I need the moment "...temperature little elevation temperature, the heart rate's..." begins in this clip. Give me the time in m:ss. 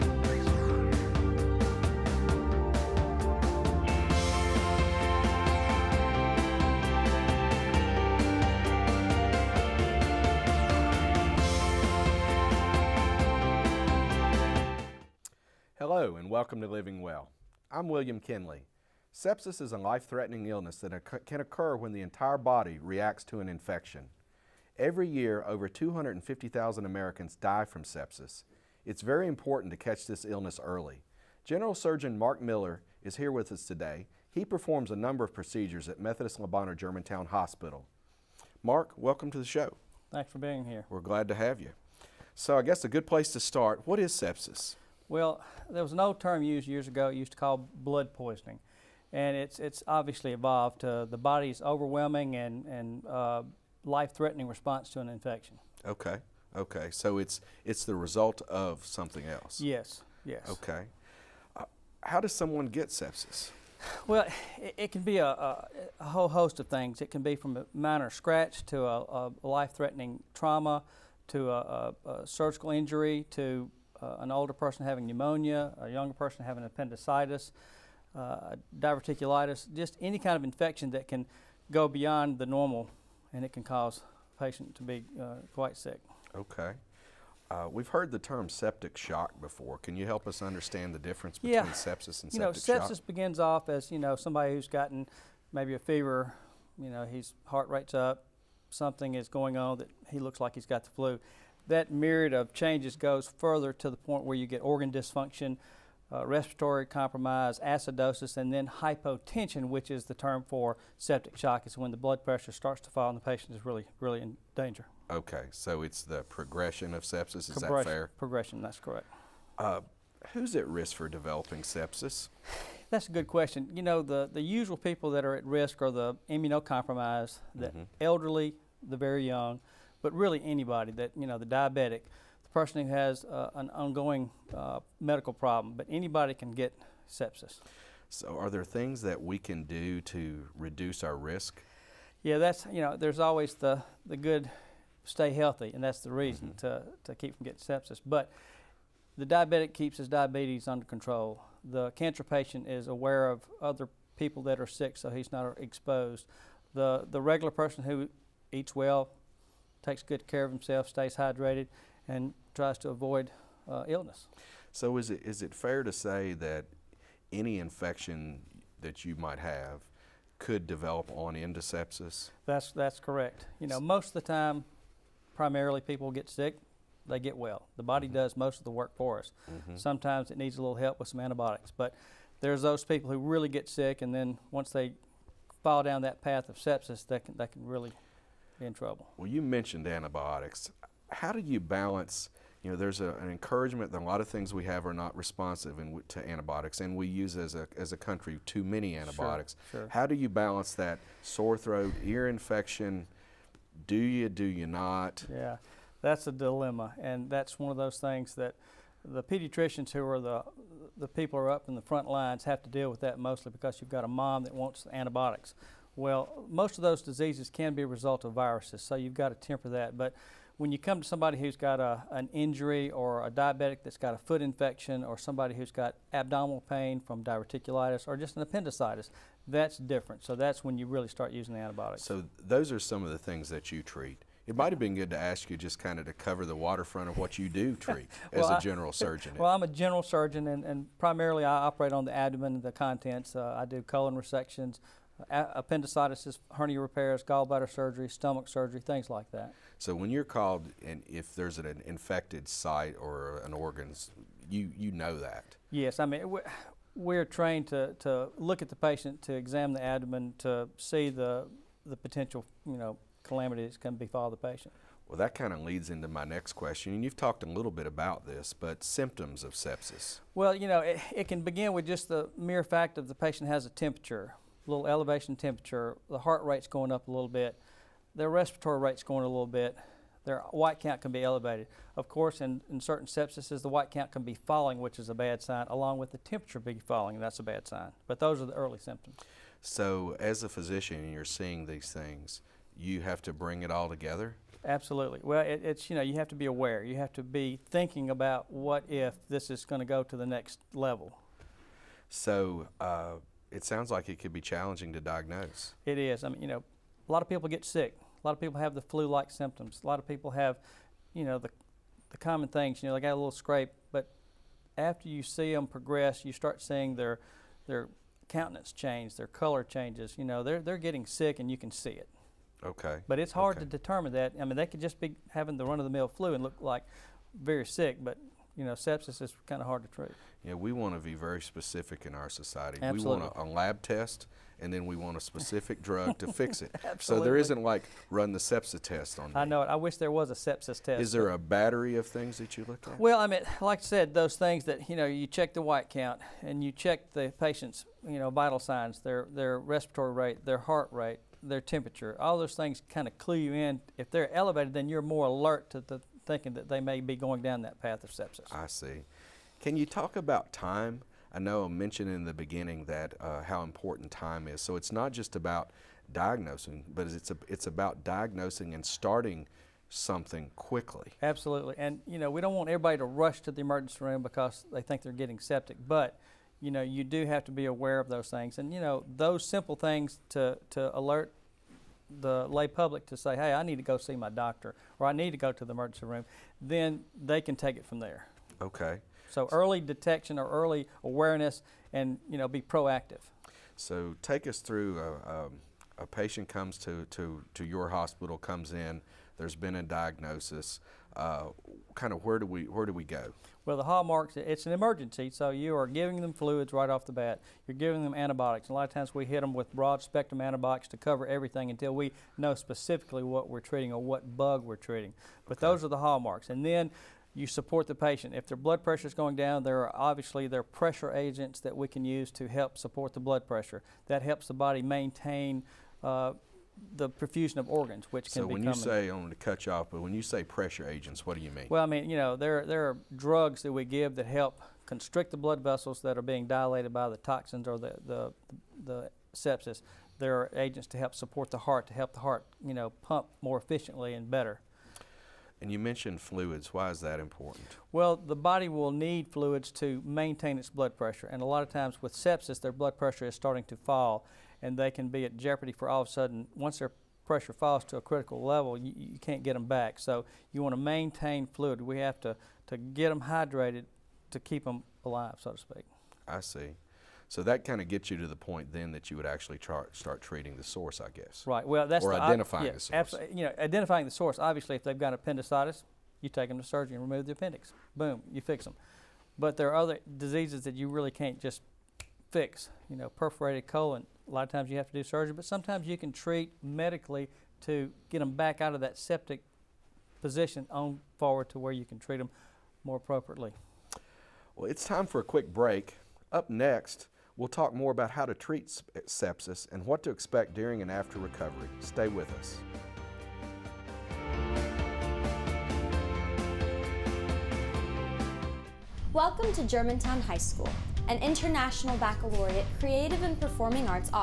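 4:33.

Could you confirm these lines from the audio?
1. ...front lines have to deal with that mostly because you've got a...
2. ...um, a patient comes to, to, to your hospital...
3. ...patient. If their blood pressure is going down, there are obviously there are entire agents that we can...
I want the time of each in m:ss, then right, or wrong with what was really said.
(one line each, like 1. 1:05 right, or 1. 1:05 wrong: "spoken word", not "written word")
1. 3:31 right
2. 6:35 right
3. 6:57 wrong: "pressure", not "entire".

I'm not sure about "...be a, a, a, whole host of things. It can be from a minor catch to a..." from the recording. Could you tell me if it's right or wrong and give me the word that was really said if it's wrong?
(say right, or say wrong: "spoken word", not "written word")
wrong: "scratch", not "catch".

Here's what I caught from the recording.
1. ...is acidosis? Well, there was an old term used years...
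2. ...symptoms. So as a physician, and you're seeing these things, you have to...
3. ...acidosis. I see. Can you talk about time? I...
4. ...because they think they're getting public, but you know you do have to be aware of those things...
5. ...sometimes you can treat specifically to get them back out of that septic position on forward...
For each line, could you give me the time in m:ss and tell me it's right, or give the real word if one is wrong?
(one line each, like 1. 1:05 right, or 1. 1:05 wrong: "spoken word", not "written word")
1. 0:43 wrong: "sepsis", not "acidosis"
2. 4:48 right
3. 5:58 wrong: "sepsis", not "acidosis"
4. 6:14 wrong: "septic", not "public"
5. 8:05 wrong: "medically", not "specifically".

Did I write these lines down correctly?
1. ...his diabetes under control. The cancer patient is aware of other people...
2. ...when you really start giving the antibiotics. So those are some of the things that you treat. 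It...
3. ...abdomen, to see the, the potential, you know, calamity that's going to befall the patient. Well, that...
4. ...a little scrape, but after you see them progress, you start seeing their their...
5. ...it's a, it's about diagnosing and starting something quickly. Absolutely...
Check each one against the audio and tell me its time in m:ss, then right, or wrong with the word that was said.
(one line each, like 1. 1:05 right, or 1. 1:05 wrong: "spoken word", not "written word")
1. 2:29 right
2. 3:50 wrong: "using", not "giving"
3. 4:19 right
4. 5:13 right
5. 6:07 right.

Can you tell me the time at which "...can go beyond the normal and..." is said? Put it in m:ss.
1:21.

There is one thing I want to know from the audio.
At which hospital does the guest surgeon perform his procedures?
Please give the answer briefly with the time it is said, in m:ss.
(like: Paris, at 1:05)
Methodist Le Bonheur Germantown Hospital, at 0:35.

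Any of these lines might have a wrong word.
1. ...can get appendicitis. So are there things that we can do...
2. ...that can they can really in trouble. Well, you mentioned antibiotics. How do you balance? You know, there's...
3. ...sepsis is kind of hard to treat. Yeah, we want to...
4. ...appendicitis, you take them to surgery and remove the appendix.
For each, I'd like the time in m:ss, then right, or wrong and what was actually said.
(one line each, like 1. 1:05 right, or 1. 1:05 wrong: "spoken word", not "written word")
1. 2:16 wrong: "sepsis", not "appendicitis"
2. 3:07 right
3. 5:28 right
4. 7:55 right.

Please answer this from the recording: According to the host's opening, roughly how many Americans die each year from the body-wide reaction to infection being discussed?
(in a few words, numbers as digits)
250,000.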